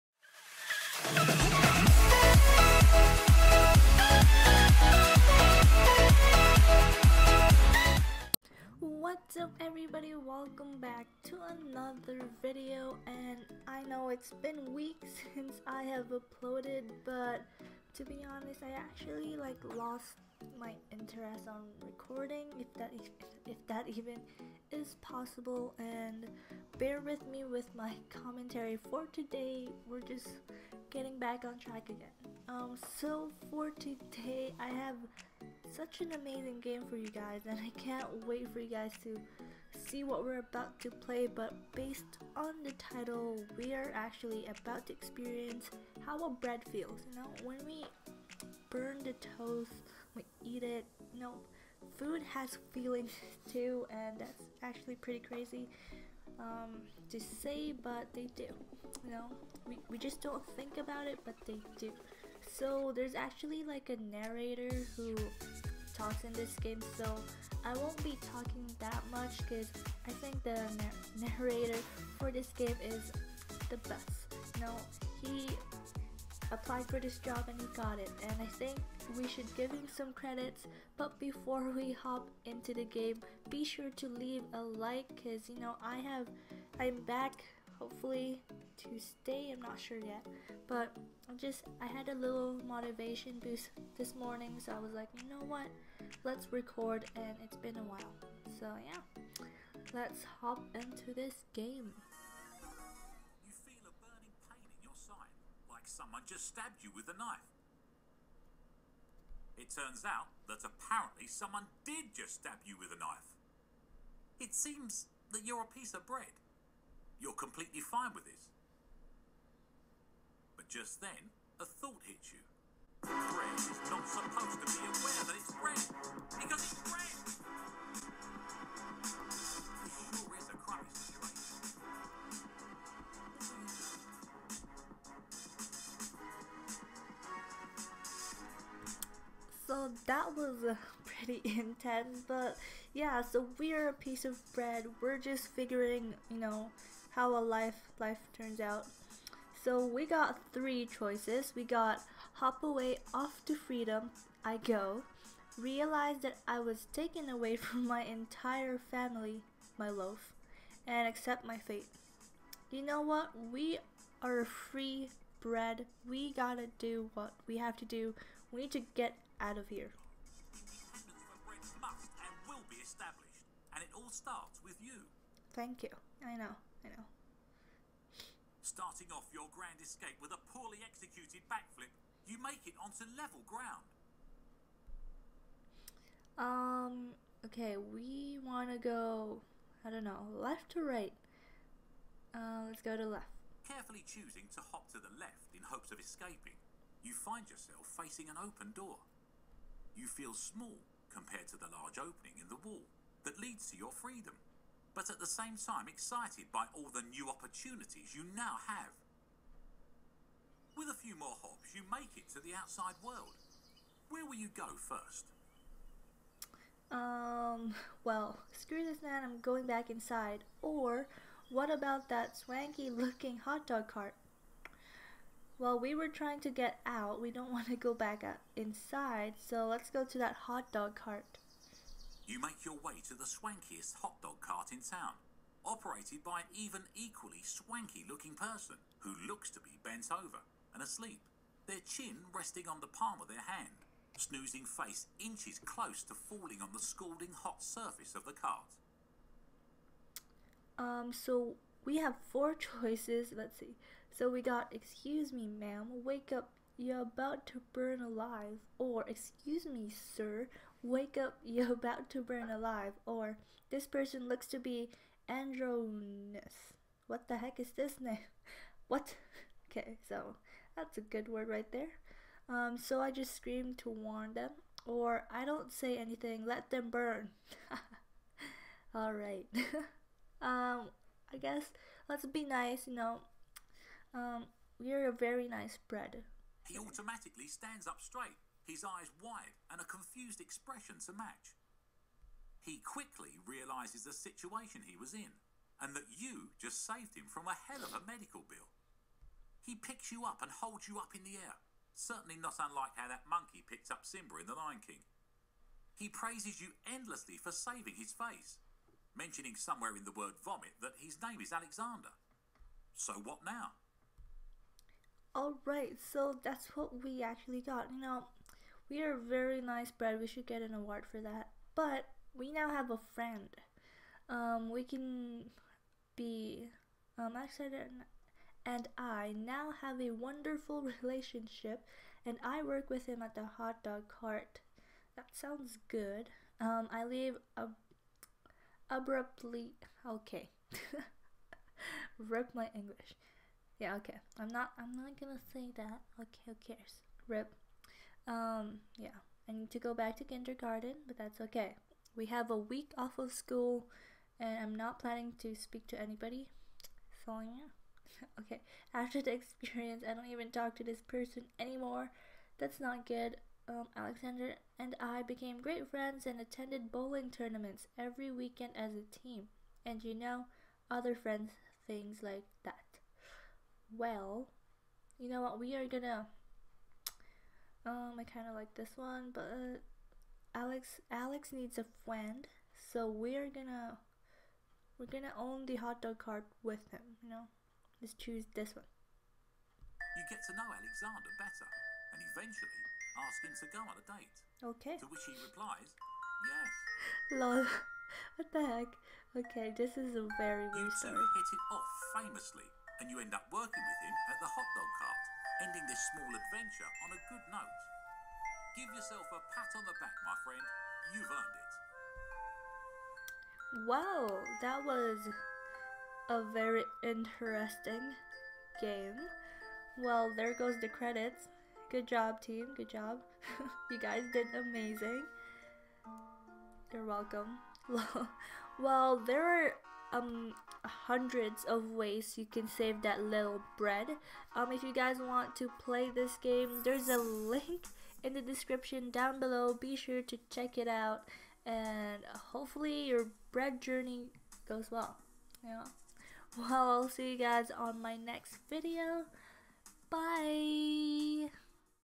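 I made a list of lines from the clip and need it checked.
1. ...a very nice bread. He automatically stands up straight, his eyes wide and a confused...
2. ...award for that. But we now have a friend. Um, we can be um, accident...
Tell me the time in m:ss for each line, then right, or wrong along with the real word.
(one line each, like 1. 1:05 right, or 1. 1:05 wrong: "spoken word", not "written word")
1. 4:45 right
2. 5:20 right.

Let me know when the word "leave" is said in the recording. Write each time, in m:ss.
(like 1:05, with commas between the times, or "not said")
1:24, 5:37.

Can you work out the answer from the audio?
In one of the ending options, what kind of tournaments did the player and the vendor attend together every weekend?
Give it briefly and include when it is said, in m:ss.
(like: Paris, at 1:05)
Bowling tournaments, at 6:06.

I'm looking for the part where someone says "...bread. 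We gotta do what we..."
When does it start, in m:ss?
2:45.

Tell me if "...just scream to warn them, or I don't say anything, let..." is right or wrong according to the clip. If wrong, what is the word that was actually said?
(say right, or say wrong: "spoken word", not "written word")
right.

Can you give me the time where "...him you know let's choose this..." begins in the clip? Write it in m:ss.
6:26.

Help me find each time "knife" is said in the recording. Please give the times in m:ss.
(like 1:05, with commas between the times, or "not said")
1:47, 1:52.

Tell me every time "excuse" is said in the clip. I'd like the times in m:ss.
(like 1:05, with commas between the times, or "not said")
4:14, 4:19.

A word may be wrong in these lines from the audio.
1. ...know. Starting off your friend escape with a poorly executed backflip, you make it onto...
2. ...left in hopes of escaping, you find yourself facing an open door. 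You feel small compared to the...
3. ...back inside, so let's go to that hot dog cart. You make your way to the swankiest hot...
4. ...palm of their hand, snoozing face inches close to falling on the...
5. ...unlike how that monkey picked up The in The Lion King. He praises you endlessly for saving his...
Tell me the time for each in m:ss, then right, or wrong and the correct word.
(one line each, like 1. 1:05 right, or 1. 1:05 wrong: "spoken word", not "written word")
1. 2:56 wrong: "grand", not "friend"
2. 3:15 right
3. 3:47 right
4. 4:02 right
5. 5:02 wrong: "Simba", not "The".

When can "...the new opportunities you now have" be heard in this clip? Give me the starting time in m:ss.
3:26.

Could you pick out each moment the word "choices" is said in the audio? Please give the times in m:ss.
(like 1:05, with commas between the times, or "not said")
2:30, 4:12.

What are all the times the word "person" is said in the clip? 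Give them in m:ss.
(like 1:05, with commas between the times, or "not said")
3:58, 4:23, 6:01.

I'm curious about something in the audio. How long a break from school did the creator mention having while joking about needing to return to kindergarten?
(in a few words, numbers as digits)
A week.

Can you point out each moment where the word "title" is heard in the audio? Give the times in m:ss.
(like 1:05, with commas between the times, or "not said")
0:42.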